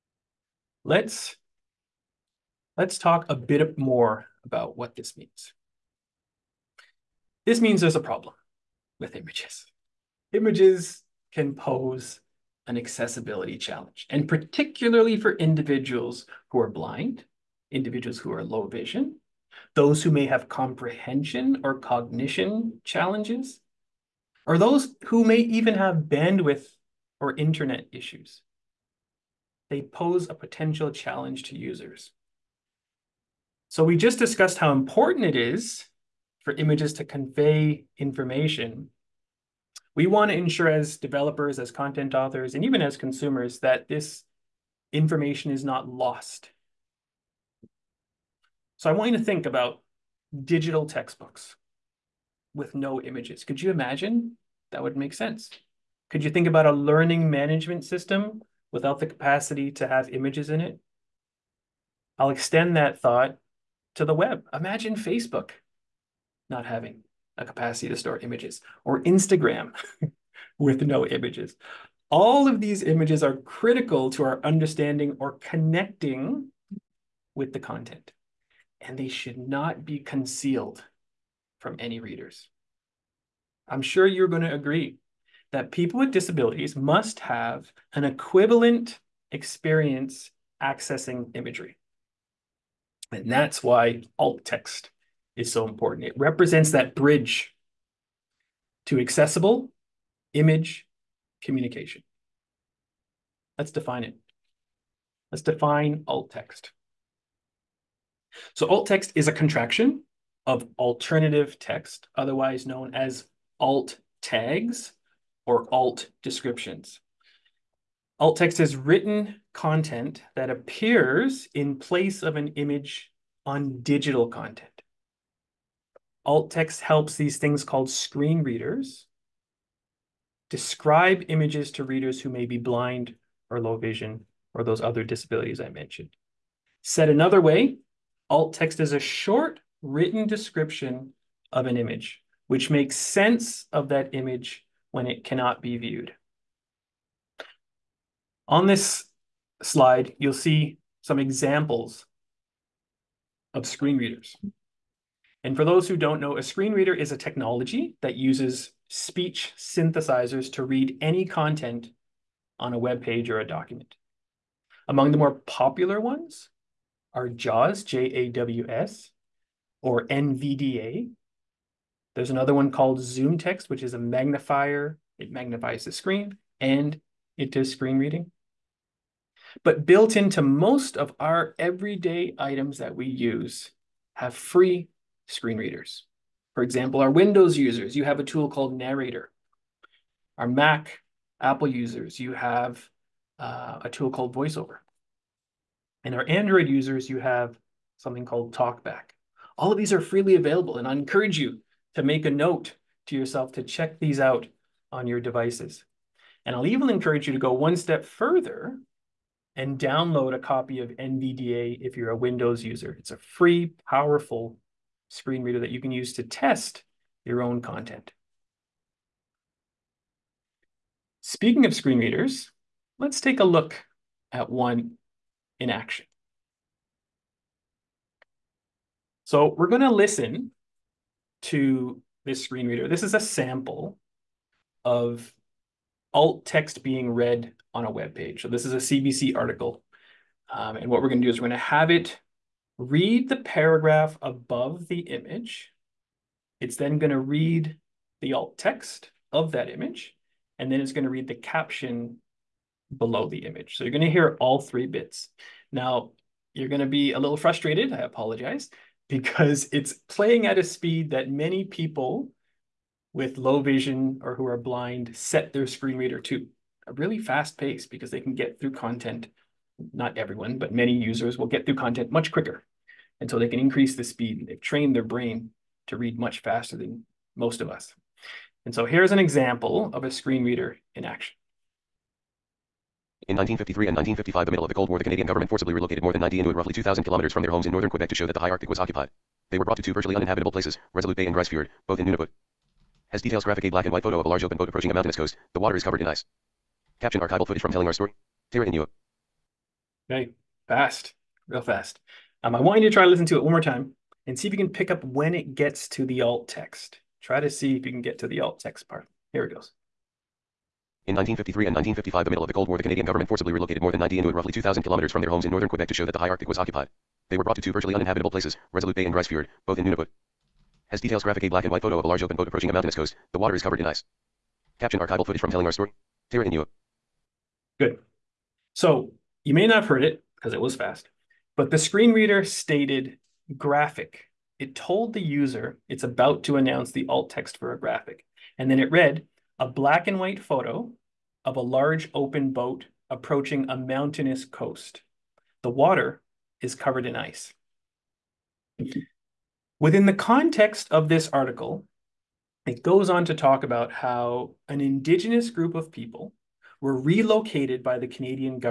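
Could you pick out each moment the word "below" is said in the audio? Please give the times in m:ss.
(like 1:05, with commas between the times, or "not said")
4:12.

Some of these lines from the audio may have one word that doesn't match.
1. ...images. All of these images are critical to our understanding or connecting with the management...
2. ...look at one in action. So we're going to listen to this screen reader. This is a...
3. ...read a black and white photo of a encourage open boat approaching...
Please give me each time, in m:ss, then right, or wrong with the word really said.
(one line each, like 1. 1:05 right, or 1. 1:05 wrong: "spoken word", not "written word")
1. 1:11 wrong: "content", not "management"
2. 3:43 right
3. 5:38 wrong: "large", not "encourage".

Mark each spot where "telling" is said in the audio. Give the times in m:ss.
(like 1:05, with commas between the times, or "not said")
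4:57, 5:25.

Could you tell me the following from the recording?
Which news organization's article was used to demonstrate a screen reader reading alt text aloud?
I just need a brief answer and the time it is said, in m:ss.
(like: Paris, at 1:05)
CBC, at 3:58.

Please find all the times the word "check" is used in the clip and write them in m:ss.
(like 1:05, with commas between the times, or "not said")
3:23.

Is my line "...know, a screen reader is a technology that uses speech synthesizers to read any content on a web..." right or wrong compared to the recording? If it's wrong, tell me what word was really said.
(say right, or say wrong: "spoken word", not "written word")
right.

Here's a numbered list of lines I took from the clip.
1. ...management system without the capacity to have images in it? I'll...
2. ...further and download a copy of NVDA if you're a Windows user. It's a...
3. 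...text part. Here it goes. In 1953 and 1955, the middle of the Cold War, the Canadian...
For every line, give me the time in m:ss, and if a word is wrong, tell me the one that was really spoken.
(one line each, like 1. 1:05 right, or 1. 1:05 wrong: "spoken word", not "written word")
1. 0:57 right
2. 3:28 right
3. 5:08 right.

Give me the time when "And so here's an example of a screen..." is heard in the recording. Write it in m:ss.
4:38.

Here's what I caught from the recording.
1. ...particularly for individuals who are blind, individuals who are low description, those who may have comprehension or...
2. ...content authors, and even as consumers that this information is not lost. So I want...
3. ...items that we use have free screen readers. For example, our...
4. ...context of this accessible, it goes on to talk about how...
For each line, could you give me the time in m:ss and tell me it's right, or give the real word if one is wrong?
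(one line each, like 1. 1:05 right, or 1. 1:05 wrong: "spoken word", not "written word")
1. 0:14 wrong: "vision", not "description"
2. 0:41 right
3. 3:02 right
4. 5:50 wrong: "article", not "accessible".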